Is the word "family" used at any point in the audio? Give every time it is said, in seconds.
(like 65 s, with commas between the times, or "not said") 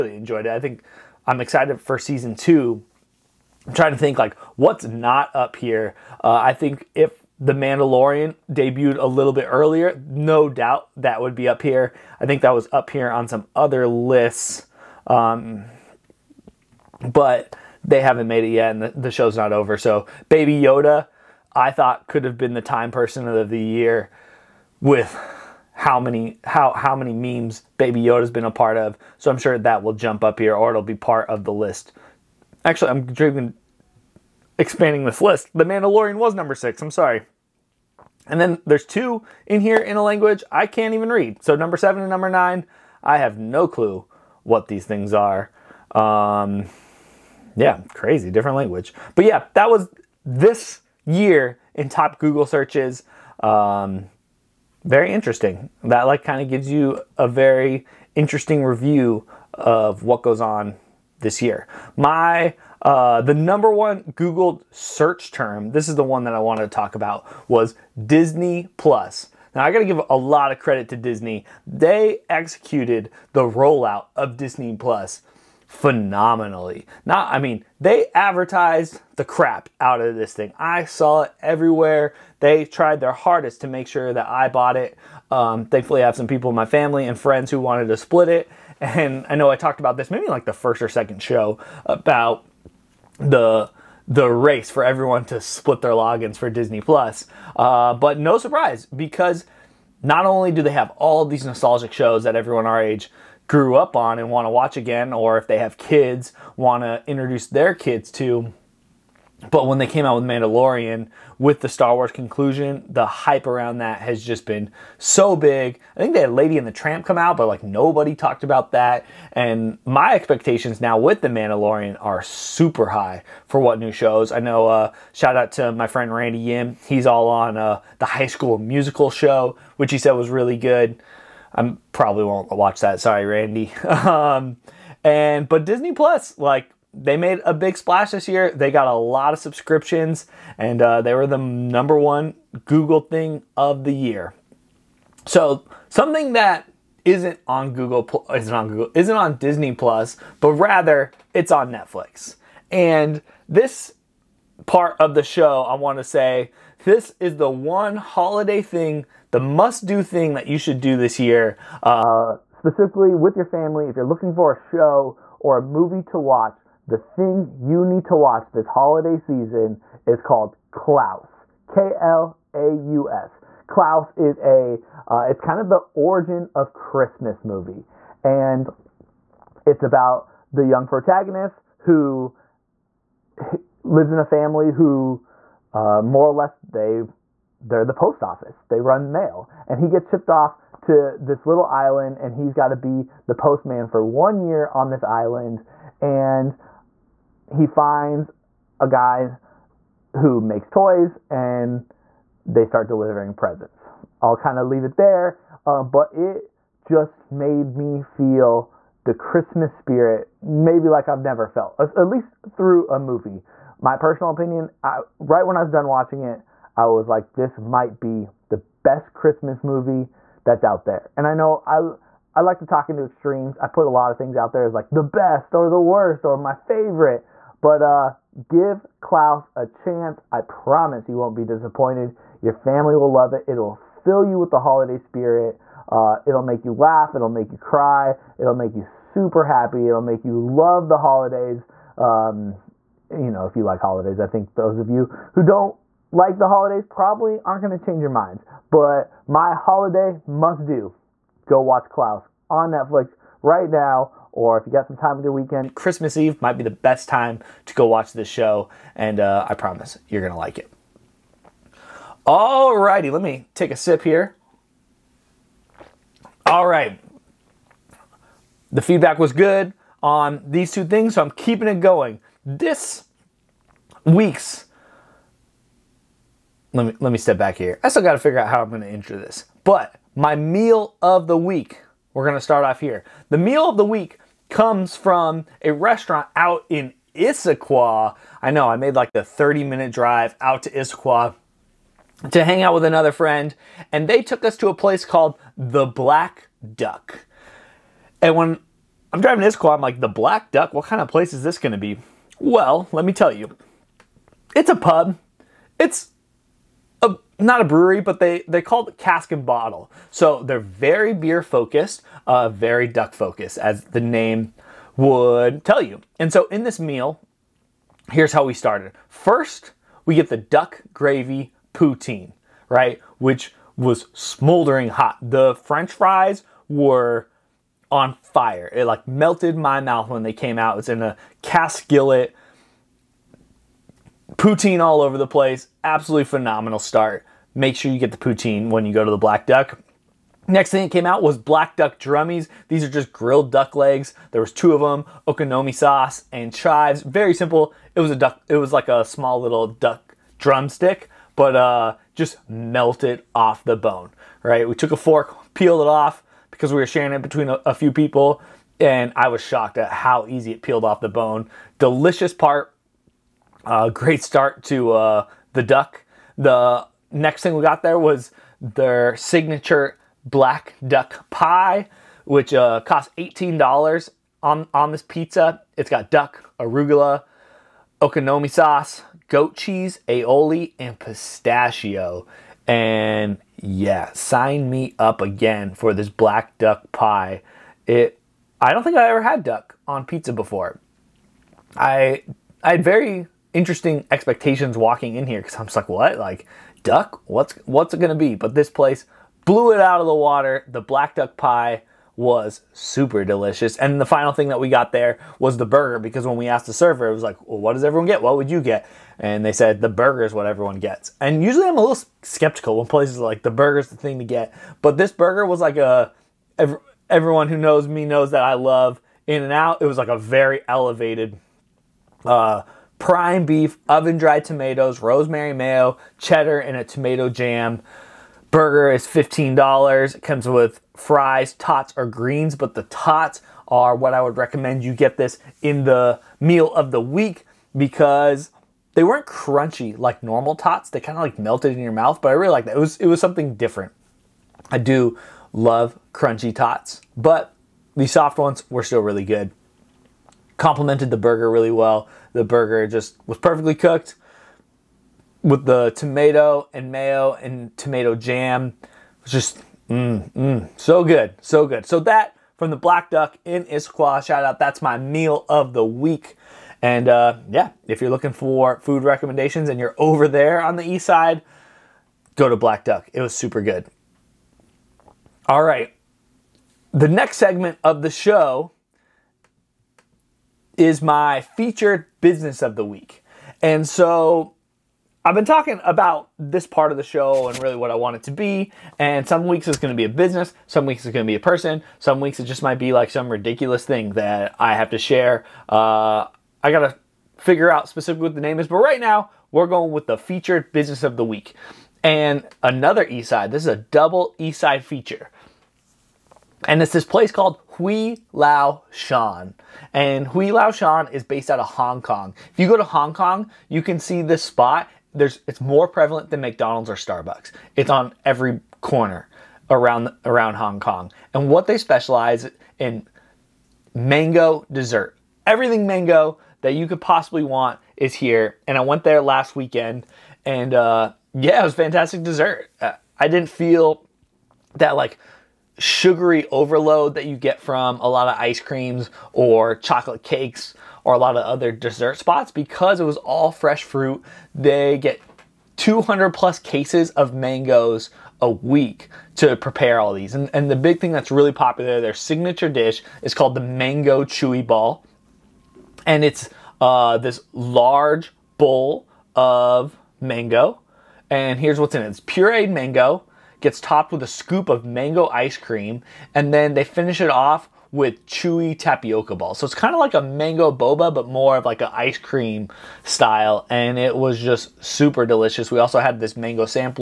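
86 s, 163 s, 184 s, 232 s.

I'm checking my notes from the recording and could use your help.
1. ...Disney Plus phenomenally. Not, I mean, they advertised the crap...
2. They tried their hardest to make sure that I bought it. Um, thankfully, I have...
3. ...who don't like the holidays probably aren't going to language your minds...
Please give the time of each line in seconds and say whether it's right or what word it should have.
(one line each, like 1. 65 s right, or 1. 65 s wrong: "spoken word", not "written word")
1. 74 s right
2. 82 s right
3. 245 s wrong: "change", not "language".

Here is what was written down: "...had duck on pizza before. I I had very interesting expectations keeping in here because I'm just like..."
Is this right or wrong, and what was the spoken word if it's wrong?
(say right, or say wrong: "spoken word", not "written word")
wrong: "walking", not "keeping".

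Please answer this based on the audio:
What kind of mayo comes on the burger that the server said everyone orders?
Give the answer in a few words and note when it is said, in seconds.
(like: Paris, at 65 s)
Rosemary mayo, at 424 s.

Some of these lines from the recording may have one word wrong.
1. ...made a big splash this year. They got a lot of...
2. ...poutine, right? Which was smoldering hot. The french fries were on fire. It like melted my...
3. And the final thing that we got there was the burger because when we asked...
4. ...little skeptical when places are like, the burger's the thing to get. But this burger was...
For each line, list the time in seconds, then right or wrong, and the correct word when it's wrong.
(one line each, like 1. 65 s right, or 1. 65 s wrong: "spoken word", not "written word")
1. 137 s right
2. 321 s right
3. 403 s right
4. 411 s right.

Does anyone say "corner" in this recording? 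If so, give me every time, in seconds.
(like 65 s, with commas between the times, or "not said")
518 s.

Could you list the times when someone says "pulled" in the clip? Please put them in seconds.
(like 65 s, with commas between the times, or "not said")
not said.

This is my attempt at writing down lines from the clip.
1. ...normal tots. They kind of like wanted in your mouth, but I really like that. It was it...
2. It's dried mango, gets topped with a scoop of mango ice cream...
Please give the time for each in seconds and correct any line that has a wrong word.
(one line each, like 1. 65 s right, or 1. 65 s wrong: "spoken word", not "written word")
1. 440 s wrong: "melted", not "wanted"
2. 562 s wrong: "pureed", not "dried".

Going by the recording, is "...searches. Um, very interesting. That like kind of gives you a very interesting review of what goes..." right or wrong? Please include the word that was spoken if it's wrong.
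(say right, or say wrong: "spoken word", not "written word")
right.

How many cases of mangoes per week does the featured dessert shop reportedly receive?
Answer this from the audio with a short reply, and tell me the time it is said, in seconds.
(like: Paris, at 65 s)
200 plus, at 545 s.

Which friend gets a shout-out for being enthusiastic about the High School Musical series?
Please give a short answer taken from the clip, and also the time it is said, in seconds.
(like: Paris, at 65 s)
Randy Yim, at 126 s.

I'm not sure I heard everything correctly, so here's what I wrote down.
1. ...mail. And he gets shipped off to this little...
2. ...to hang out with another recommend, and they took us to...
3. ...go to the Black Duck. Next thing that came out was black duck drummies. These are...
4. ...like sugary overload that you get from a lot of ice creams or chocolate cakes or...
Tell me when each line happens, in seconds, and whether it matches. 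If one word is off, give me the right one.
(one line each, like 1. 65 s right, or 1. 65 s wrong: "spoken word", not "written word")
1. 189 s right
2. 292 s wrong: "friend", not "recommend"
3. 338 s right
4. 534 s right.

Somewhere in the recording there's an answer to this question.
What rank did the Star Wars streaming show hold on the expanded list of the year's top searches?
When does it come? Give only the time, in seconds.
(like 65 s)
36 s.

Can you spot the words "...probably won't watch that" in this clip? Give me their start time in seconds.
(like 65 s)
131 s.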